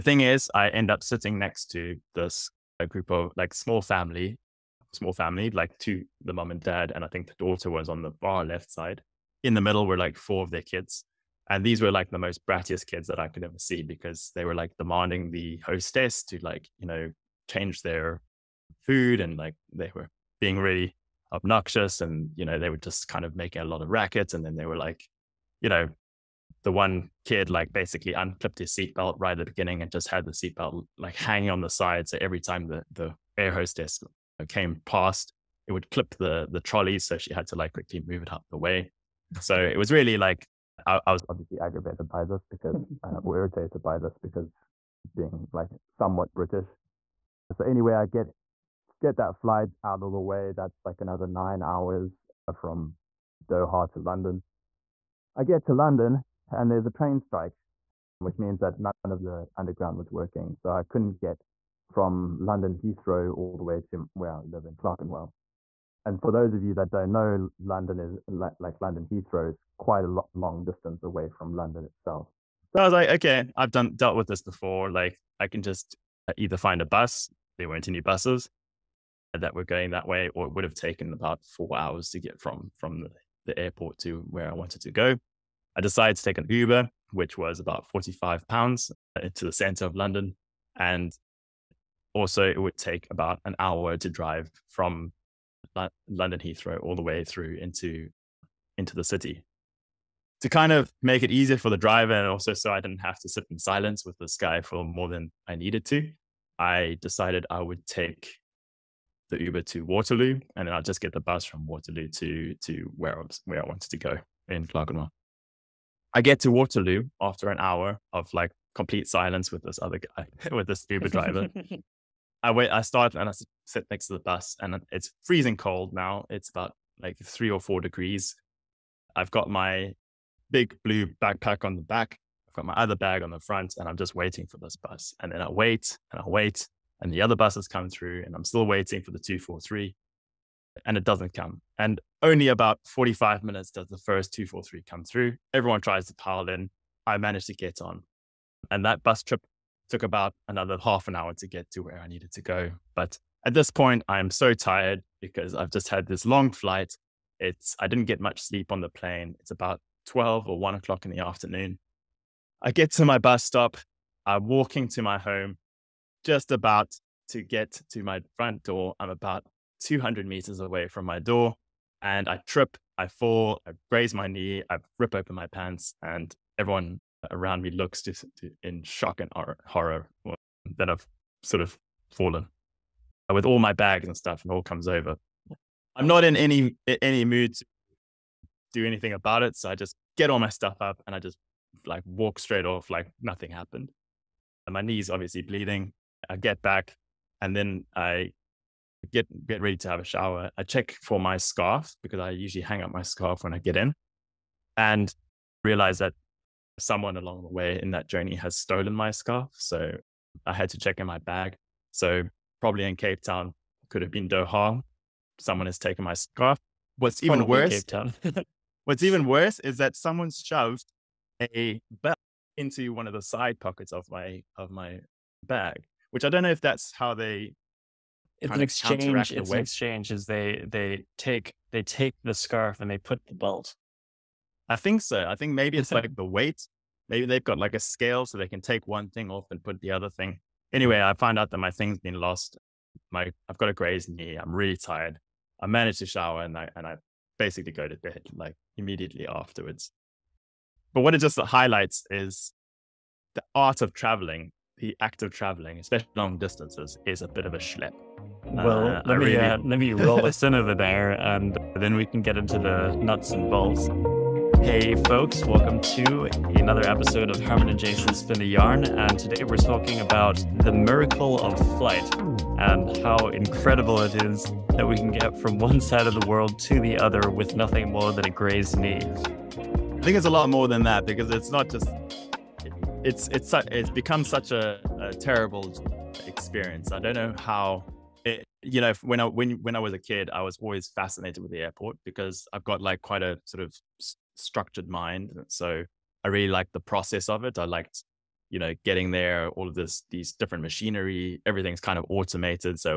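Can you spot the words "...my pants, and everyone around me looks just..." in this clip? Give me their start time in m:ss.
2:55.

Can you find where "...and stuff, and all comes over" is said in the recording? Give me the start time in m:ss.
3:04.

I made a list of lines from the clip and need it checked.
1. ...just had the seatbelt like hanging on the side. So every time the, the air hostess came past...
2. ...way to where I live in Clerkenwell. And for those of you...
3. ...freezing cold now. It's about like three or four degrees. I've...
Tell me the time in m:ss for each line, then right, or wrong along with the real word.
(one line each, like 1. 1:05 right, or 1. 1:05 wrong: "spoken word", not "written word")
1. 0:29 right
2. 1:03 right
3. 2:05 right.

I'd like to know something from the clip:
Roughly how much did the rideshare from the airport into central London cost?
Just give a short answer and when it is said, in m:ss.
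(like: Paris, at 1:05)
45 pounds, at 1:27.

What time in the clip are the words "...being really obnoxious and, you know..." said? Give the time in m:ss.
0:20.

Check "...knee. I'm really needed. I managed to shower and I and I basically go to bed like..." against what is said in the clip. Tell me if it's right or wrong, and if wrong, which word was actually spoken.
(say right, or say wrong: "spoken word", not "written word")
wrong: "tired", not "needed".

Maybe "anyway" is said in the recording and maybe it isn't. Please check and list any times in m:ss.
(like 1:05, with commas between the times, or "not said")
0:47, 4:00.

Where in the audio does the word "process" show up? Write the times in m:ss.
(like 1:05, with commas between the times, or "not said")
4:56.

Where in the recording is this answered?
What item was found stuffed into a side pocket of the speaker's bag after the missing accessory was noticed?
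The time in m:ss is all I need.
3:41.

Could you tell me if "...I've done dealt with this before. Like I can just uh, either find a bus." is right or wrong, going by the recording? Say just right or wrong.
right.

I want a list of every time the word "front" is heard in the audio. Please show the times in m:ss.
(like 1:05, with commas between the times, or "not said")
2:13, 2:48.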